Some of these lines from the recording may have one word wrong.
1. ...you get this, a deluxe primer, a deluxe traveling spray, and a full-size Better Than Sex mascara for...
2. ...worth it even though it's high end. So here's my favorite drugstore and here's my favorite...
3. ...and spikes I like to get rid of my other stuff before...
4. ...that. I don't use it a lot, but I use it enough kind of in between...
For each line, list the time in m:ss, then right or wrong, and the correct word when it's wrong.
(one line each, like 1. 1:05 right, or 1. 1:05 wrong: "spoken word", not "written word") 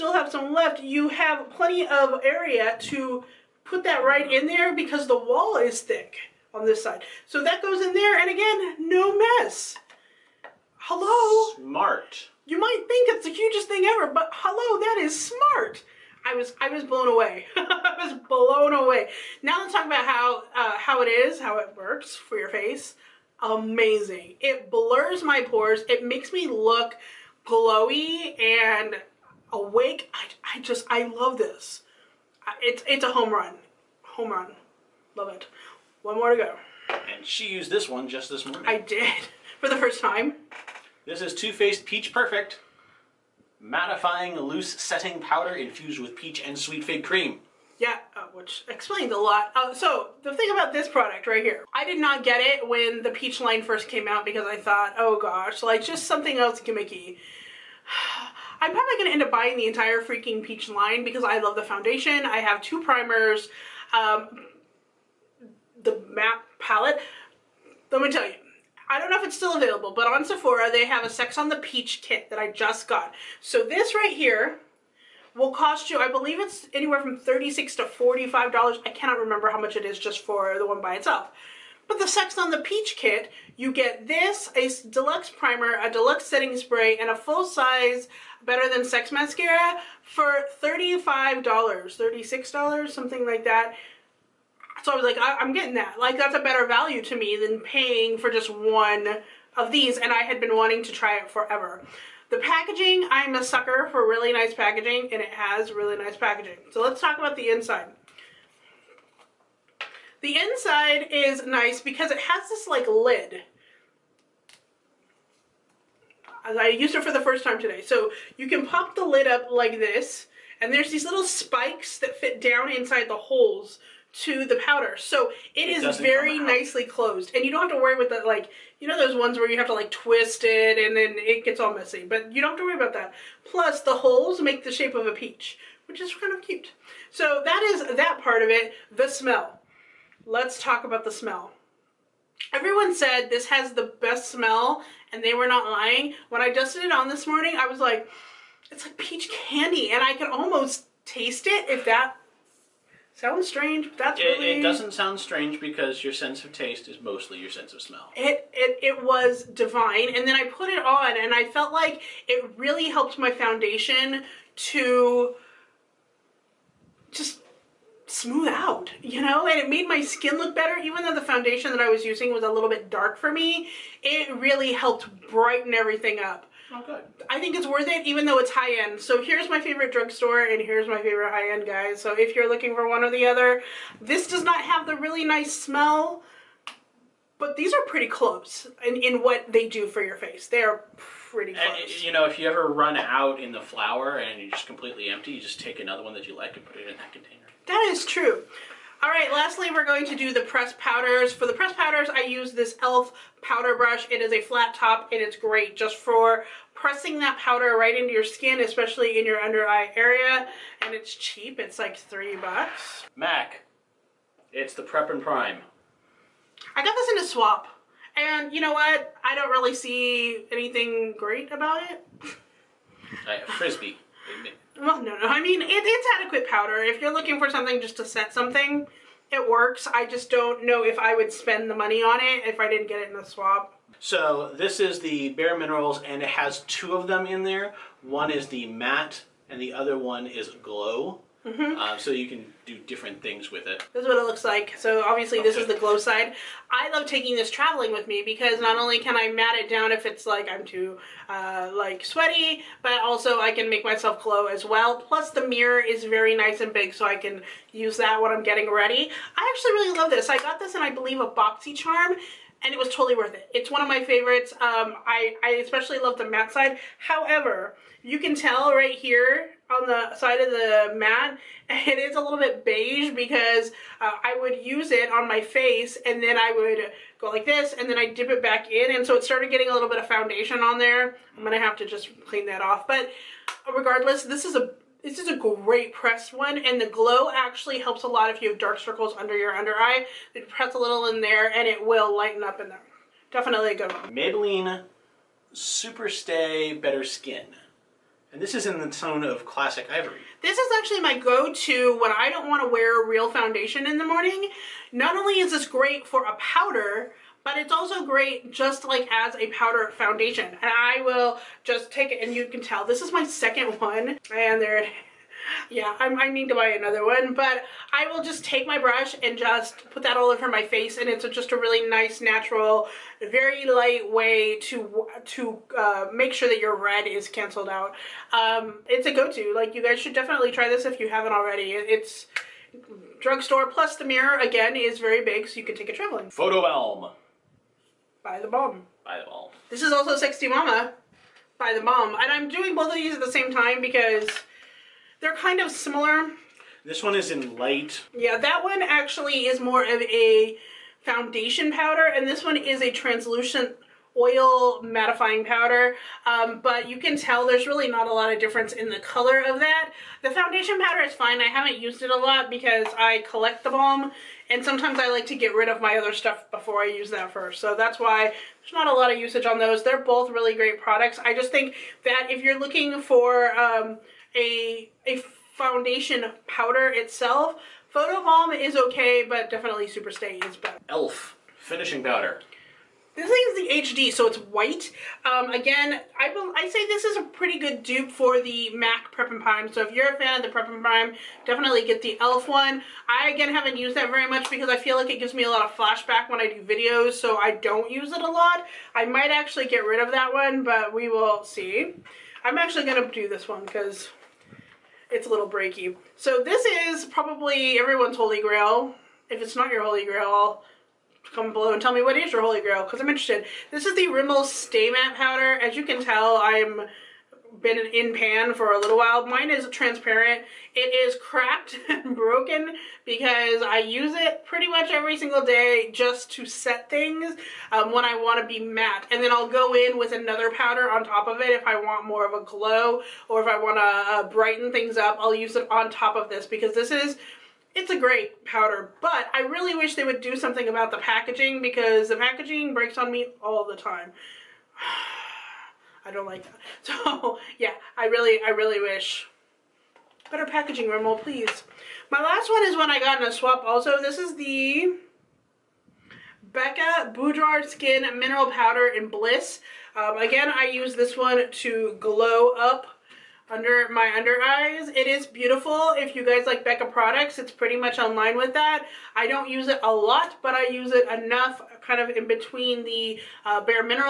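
1. 1:23 wrong: "setting", not "traveling"
2. 2:57 right
3. 6:04 wrong: "sometimes", not "spikes"
4. 7:48 right.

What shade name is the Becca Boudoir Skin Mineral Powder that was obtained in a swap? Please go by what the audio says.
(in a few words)
Bliss.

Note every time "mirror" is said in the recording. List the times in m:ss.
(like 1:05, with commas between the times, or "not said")
4:15, 5:34.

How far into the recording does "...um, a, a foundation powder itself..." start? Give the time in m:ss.
6:13.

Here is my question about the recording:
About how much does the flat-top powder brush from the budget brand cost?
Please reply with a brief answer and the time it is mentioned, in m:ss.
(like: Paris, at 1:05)
3 dollars, at 3:31.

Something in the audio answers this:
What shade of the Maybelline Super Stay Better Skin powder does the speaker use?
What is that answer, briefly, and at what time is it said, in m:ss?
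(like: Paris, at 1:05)
classic ivory, at 4:59.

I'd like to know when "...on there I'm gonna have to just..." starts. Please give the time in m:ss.
4:40.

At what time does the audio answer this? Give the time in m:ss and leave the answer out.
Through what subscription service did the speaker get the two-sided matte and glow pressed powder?
4:21.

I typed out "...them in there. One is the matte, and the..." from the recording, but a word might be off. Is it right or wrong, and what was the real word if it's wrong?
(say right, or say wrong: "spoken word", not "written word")
right.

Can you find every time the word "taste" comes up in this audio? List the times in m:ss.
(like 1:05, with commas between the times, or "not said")
2:31, 2:36.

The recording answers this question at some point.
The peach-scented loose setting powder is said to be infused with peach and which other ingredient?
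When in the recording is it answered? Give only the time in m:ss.
0:46.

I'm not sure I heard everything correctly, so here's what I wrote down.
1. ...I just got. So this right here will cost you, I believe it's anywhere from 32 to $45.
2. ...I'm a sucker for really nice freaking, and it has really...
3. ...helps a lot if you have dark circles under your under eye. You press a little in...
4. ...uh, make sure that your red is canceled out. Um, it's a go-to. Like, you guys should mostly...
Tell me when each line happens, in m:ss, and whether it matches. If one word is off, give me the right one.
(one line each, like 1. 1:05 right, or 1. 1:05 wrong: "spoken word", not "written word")
1. 1:12 wrong: "36", not "32"
2. 1:43 wrong: "packaging", not "freaking"
3. 4:47 right
4. 5:25 wrong: "definitely", not "mostly".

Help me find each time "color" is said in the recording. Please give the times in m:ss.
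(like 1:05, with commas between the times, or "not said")
5:58.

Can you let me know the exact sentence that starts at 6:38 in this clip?
I might actually get rid of that one, but we will see.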